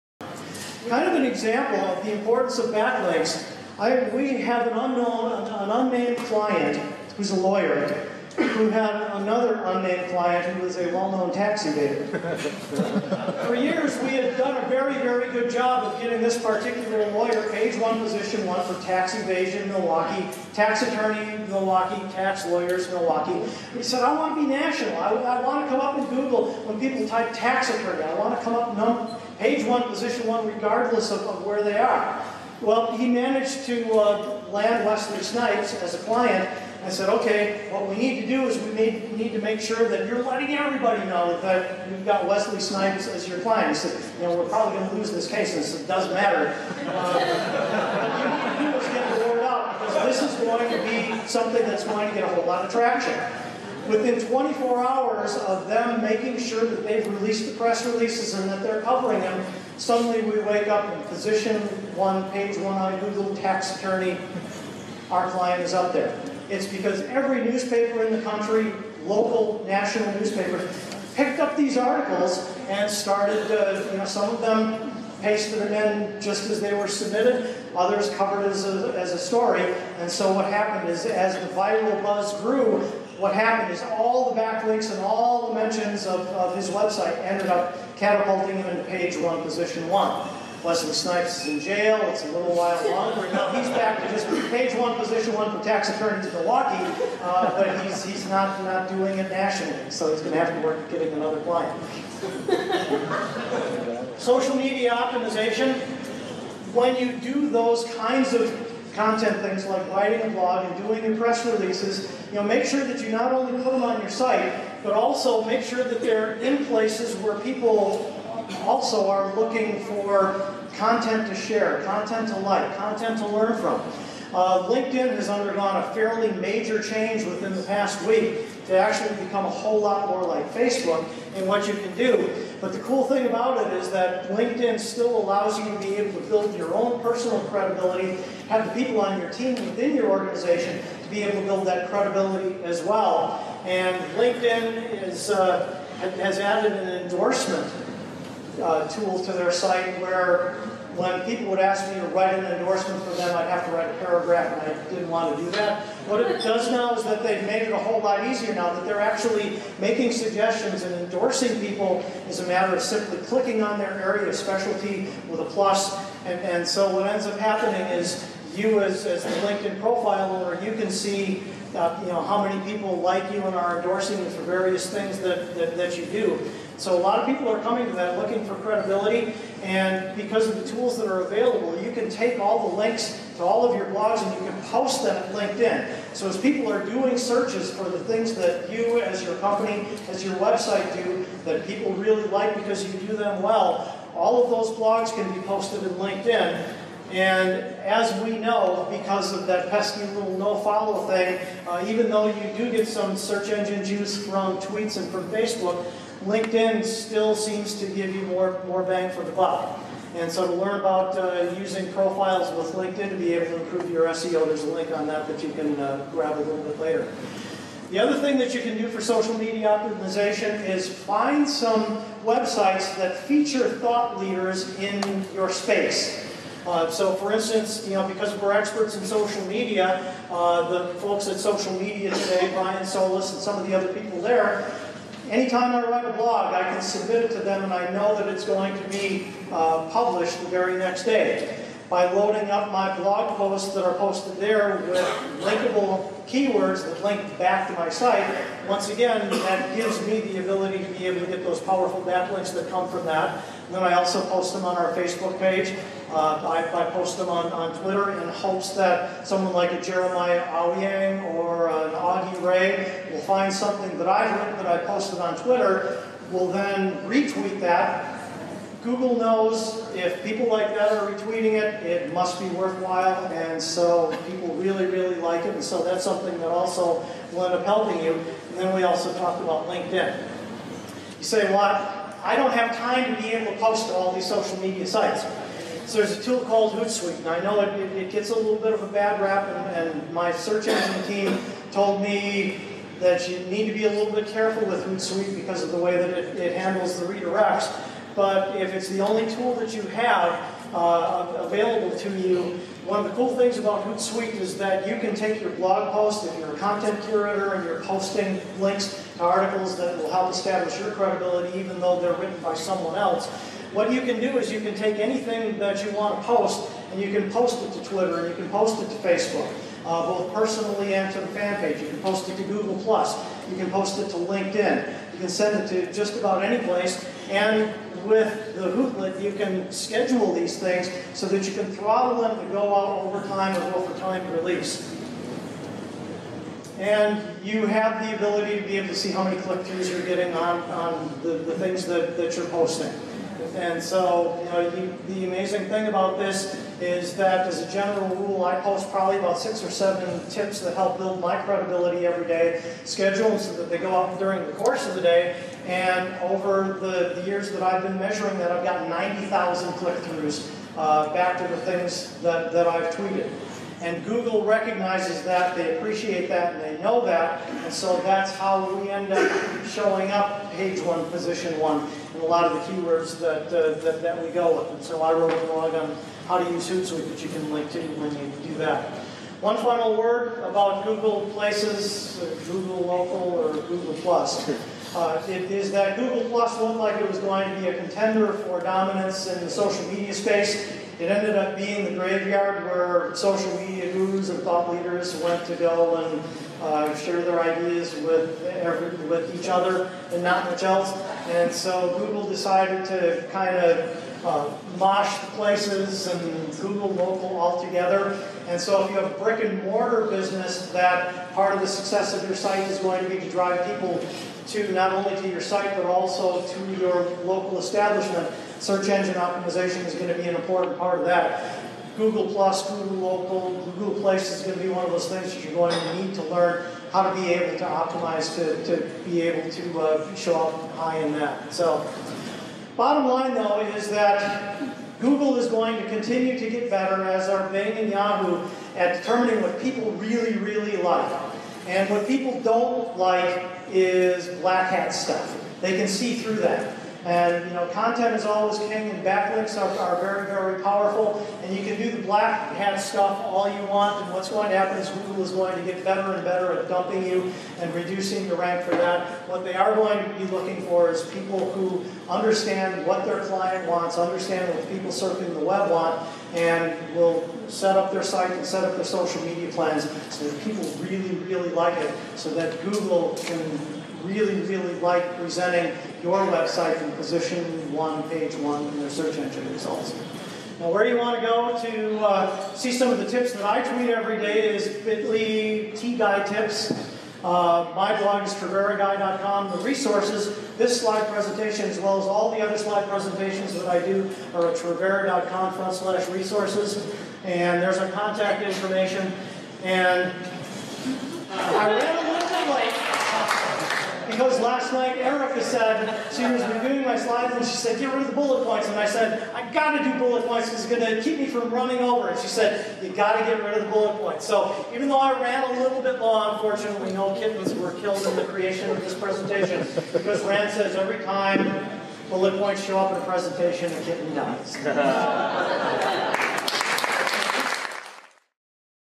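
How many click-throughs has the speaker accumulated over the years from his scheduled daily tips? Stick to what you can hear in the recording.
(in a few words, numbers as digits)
90,000.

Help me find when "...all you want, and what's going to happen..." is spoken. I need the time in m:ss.
7:33.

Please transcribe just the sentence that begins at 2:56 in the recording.
So a lot of people are coming to that looking for credibility.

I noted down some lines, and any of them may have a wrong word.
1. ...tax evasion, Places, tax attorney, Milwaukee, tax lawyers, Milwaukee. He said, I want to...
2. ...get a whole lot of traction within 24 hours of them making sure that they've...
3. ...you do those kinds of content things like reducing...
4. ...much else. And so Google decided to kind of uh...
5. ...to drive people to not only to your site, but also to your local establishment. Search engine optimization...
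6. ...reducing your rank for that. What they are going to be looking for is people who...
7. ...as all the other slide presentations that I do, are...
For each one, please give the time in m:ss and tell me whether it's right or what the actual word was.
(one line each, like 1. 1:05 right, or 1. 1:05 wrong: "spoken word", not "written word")
1. 0:18 wrong: "Milwaukee", not "Places"
2. 0:52 right
3. 1:46 wrong: "writing", not "reducing"
4. 6:40 right
5. 6:53 right
6. 7:37 right
7. 8:11 right.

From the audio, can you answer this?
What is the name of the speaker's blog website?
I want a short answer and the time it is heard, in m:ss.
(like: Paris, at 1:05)
Triveraguy.com, at 8:08.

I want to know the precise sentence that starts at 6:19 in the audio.
One final word about Google Places, Google Local, or Google Plus.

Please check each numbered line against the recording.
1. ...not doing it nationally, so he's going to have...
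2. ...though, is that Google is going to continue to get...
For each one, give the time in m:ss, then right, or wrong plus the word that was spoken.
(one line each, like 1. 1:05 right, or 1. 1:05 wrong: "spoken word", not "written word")
1. 1:38 right
2. 7:13 right.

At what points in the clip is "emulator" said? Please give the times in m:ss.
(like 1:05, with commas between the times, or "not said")
not said.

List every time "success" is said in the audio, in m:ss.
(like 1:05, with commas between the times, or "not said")
6:51.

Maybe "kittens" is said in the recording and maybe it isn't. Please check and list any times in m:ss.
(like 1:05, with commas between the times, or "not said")
8:37, 8:43.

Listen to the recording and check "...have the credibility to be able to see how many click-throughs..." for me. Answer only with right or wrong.
wrong.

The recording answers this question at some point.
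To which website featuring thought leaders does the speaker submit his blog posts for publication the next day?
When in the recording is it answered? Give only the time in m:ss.
3:51.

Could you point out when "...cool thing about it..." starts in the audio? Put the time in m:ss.
2:12.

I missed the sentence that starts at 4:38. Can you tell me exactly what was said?
And then we also talked about LinkedIn.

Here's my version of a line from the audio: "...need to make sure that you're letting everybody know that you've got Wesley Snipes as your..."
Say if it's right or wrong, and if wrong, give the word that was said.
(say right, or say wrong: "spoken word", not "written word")
right.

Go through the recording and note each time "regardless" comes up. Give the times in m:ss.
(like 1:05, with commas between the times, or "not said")
0:30.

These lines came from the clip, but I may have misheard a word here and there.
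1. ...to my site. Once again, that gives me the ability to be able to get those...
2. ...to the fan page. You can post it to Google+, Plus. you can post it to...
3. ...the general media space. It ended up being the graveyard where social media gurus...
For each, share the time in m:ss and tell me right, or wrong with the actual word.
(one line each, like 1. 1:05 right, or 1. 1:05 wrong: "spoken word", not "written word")
1. 4:07 right
2. 5:21 right
3. 6:29 wrong: "social", not "general".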